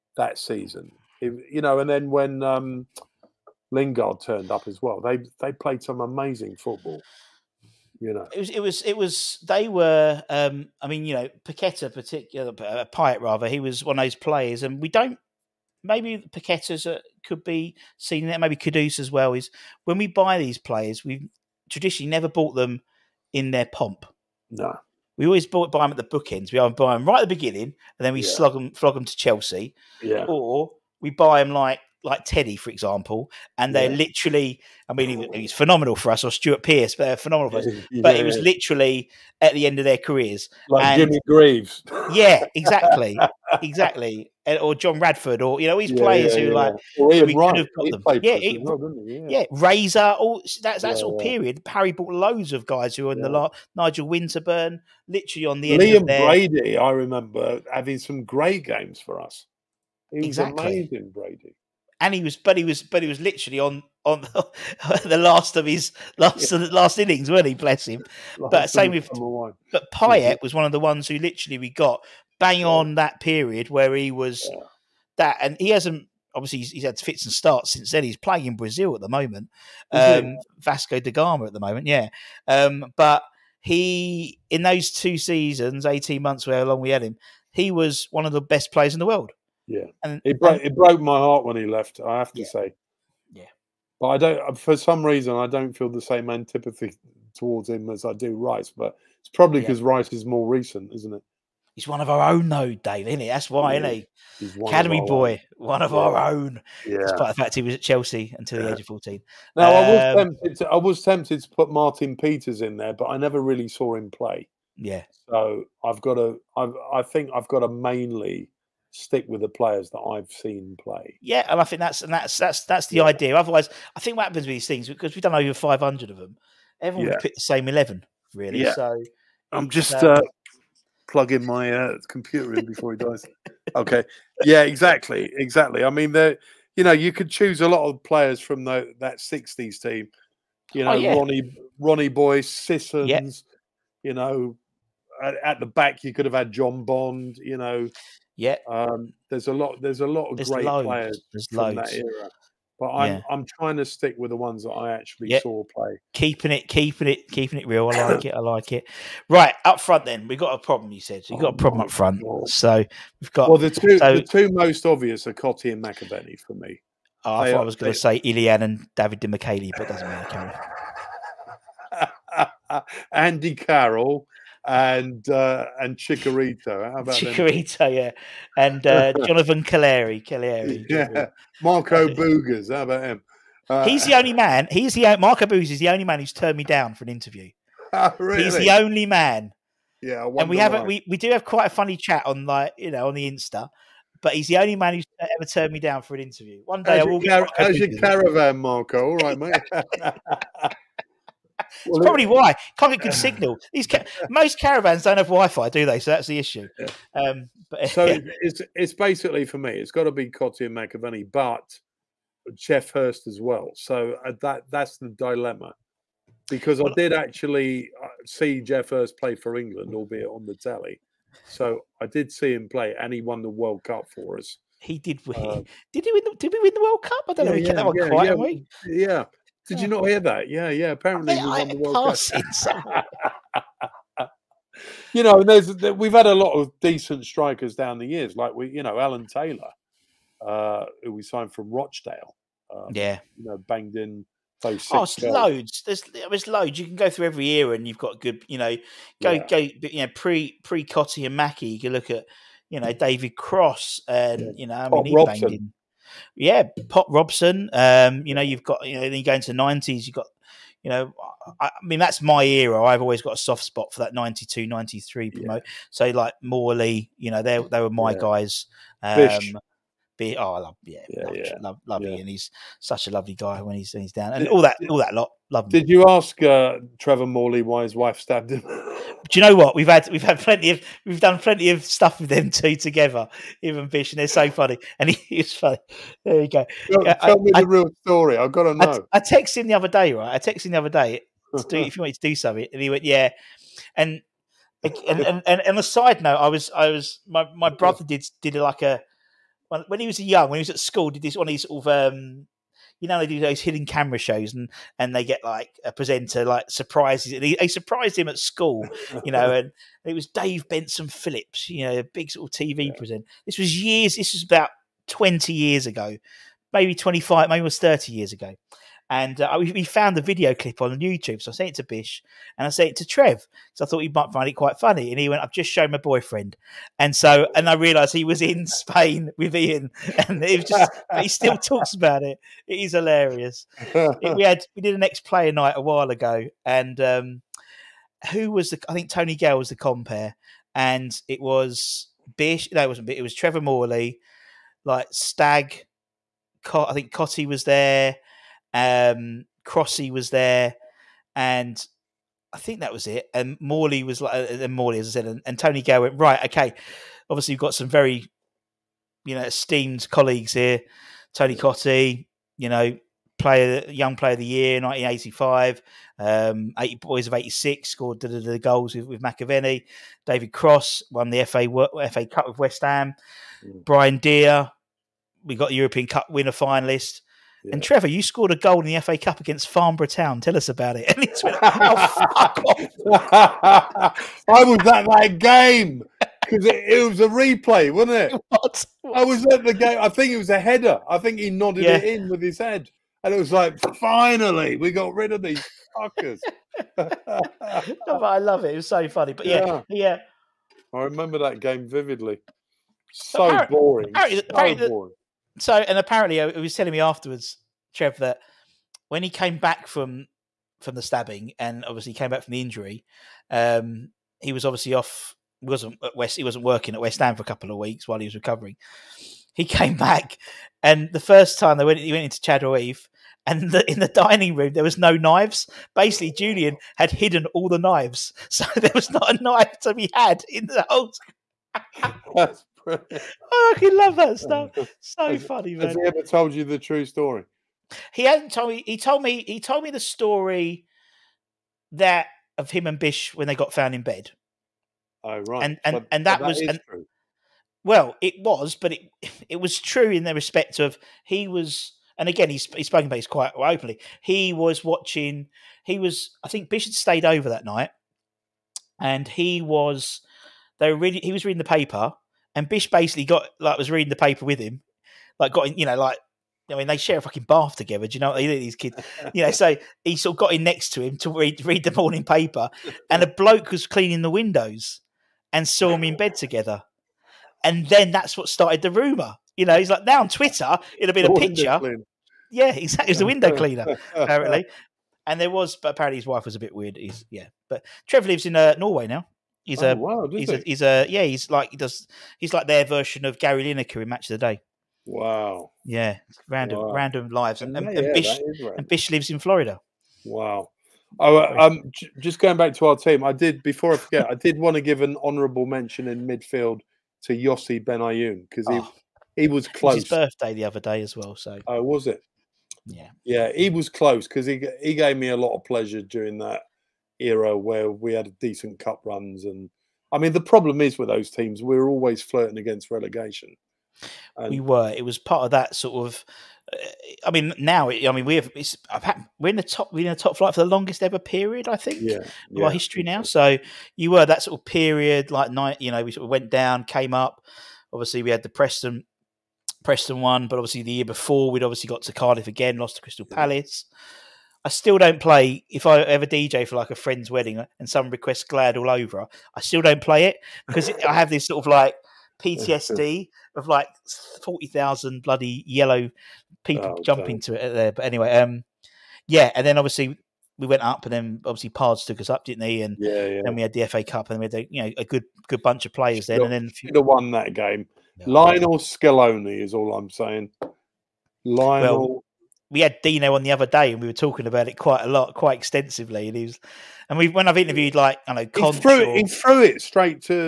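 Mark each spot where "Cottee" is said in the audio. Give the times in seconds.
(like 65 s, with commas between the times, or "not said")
165 s, 210 s, 250 s, 347 s, 361 s.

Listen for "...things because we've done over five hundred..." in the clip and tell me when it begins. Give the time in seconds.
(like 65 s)
124 s.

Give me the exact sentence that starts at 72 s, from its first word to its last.
on that period where he was yeah.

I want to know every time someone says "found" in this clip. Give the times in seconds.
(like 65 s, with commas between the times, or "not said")
319 s, 443 s.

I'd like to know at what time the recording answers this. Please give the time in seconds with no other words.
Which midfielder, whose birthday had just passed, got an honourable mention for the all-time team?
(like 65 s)
507 s.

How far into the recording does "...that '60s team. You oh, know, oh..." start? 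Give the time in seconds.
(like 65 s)
138 s.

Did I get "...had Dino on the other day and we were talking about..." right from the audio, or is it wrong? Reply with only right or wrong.
right.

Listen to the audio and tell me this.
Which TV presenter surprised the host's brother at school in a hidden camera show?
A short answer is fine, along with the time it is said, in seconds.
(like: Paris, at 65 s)
Dave Benson Phillips, at 310 s.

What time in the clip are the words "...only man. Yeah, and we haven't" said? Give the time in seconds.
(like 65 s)
188 s.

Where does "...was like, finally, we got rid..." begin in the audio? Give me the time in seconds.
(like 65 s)
393 s.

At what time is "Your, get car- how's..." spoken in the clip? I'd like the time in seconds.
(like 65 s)
197 s.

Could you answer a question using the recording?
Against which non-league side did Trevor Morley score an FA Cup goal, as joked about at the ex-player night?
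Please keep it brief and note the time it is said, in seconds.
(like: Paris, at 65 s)
Farnborough Town, at 379 s.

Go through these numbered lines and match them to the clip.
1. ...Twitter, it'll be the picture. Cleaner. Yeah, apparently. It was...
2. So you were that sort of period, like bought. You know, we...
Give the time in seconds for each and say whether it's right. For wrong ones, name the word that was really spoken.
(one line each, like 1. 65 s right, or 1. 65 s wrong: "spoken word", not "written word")
1. 480 s wrong: "exactly", not "apparently"
2. 533 s wrong: "night", not "bought".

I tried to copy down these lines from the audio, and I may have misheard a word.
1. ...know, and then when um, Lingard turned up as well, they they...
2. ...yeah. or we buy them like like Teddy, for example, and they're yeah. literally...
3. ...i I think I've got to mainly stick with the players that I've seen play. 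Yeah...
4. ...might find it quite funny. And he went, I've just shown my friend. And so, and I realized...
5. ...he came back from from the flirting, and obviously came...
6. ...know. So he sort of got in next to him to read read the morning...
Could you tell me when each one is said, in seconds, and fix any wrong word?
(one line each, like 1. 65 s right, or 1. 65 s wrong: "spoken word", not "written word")
1. 1 s right
2. 29 s right
3. 116 s right
4. 324 s wrong: "boyfriend", not "friend"
5. 409 s wrong: "stabbing", not "flirting"
6. 469 s right.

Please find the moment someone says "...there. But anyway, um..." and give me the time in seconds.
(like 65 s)
557 s.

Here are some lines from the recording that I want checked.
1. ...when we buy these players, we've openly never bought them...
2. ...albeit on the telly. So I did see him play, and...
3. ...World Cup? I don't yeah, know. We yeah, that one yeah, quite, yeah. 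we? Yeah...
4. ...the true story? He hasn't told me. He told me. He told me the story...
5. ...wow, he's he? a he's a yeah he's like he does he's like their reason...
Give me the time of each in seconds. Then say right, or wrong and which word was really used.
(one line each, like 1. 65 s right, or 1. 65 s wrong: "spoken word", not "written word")
1. 19 s wrong: "traditionally", not "openly"
2. 219 s right
3. 226 s right
4. 436 s right
5. 489 s wrong: "version", not "reason".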